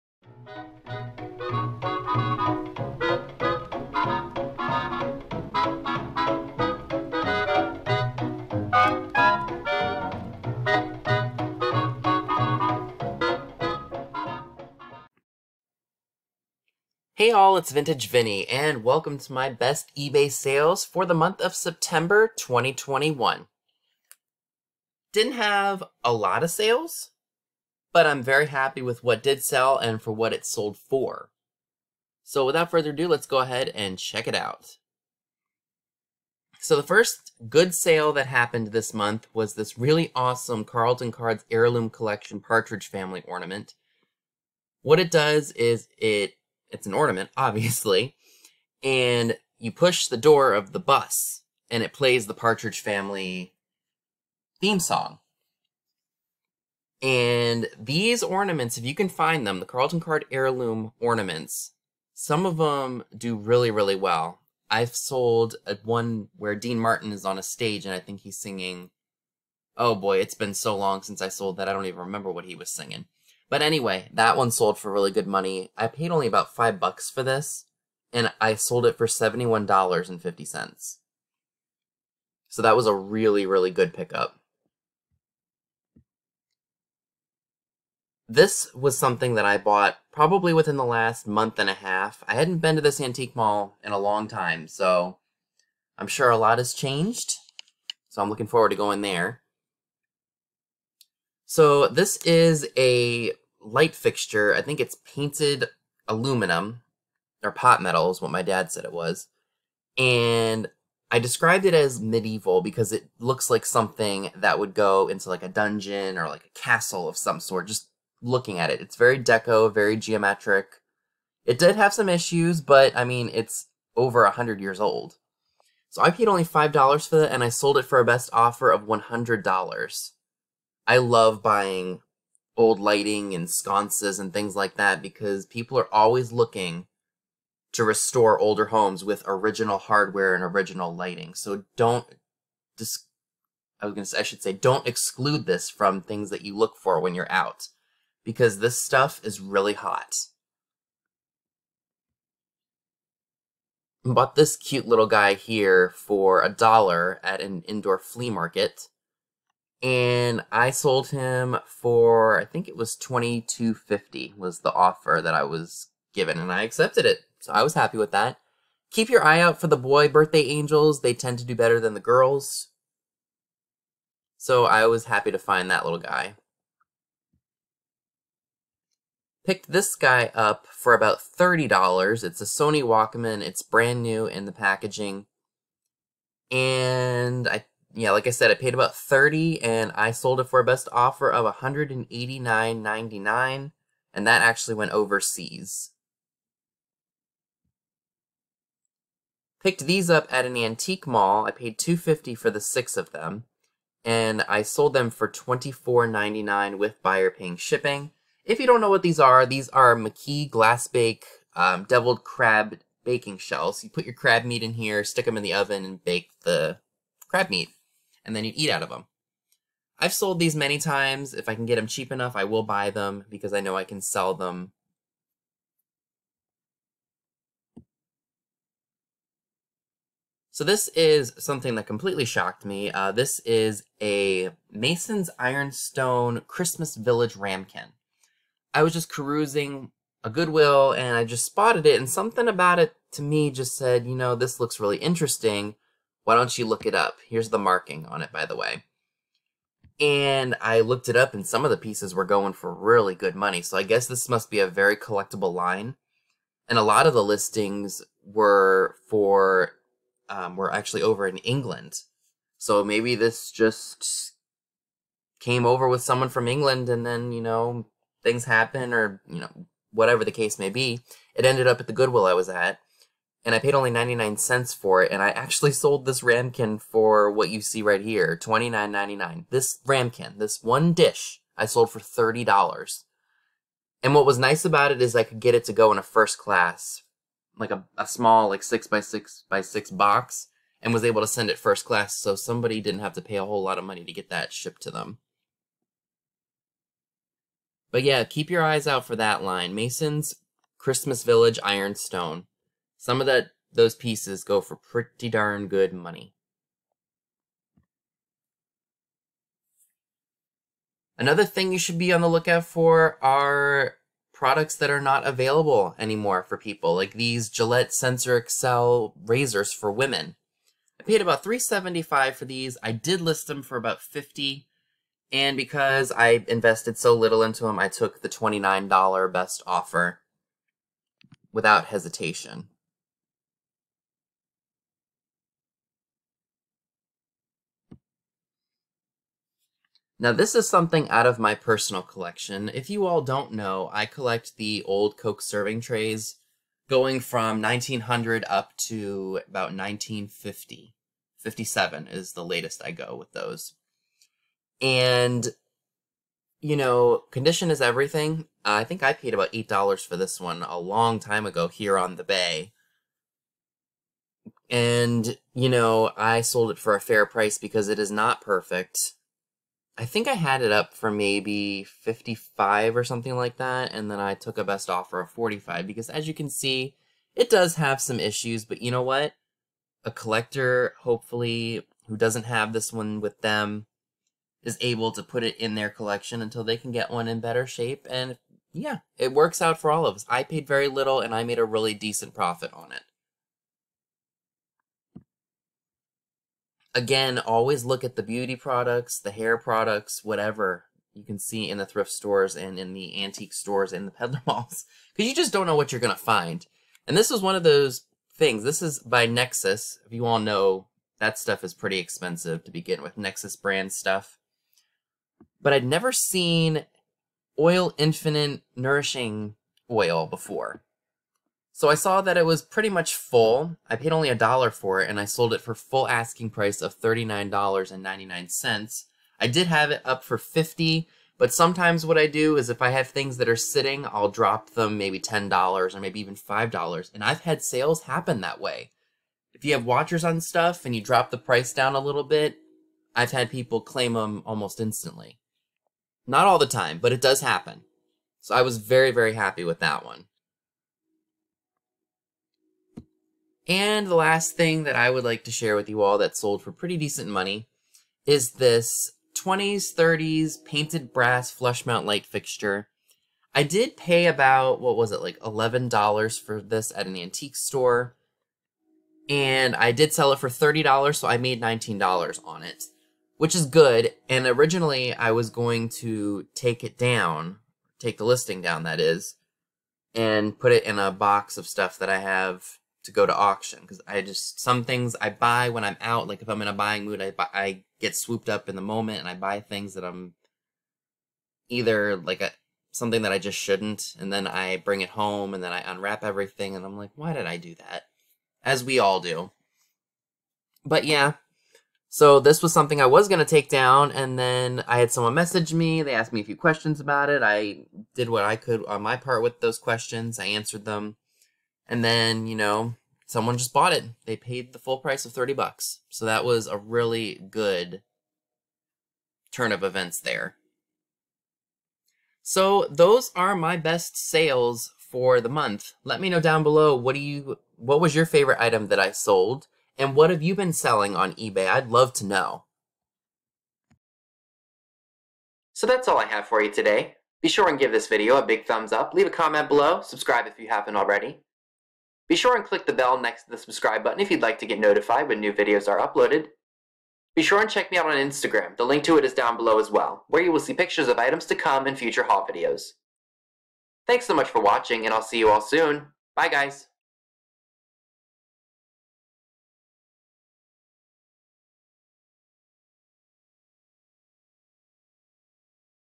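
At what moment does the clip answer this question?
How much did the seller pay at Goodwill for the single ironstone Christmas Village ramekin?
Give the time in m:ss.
4:33.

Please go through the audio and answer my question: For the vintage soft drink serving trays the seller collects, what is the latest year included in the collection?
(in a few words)
1957.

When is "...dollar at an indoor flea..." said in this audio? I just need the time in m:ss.
2:36.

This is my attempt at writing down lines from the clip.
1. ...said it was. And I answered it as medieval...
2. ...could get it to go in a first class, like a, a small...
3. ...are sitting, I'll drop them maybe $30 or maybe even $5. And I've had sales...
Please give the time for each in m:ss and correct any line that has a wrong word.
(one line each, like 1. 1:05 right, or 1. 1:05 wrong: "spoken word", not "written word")
1. 1:48 wrong: "described", not "answered"
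2. 4:45 right
3. 7:13 wrong: "10", not "30".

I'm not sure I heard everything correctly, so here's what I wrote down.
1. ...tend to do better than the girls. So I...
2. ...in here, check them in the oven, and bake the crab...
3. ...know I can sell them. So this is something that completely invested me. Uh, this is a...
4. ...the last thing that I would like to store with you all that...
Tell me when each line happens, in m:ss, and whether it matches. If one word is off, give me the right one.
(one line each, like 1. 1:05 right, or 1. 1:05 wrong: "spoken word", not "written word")
1. 2:51 right
2. 3:34 wrong: "stick", not "check"
3. 3:43 wrong: "shocked", not "invested"
4. 7:34 wrong: "share", not "store".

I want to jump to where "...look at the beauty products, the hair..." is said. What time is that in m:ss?
6:37.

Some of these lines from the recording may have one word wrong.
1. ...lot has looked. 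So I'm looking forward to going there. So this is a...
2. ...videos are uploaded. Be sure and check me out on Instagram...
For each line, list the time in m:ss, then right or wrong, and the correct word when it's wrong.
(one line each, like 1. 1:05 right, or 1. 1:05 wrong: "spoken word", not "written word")
1. 1:36 wrong: "changed", not "looked"
2. 9:05 right.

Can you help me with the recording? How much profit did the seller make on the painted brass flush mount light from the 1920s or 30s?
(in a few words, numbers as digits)
$19.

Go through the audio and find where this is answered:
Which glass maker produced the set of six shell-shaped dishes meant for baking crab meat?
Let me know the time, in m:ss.
3:29.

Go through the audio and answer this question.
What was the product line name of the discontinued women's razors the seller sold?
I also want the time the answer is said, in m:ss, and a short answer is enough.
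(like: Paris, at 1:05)
Sensor Excel, at 5:17.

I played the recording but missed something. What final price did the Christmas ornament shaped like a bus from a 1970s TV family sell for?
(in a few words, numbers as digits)
$71.50.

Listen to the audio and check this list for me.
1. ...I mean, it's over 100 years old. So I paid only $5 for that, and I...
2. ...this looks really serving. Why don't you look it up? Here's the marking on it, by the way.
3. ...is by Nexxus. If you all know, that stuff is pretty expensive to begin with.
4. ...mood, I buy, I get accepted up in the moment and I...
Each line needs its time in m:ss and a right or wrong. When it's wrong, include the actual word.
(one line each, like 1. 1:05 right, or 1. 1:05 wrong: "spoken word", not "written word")
1. 2:02 right
2. 4:04 wrong: "interesting", not "serving"
3. 6:48 right
4. 8:07 wrong: "swooped", not "accepted".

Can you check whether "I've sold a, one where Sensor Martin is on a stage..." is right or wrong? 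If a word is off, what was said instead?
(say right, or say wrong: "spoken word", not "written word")
wrong: "Dean", not "Sensor".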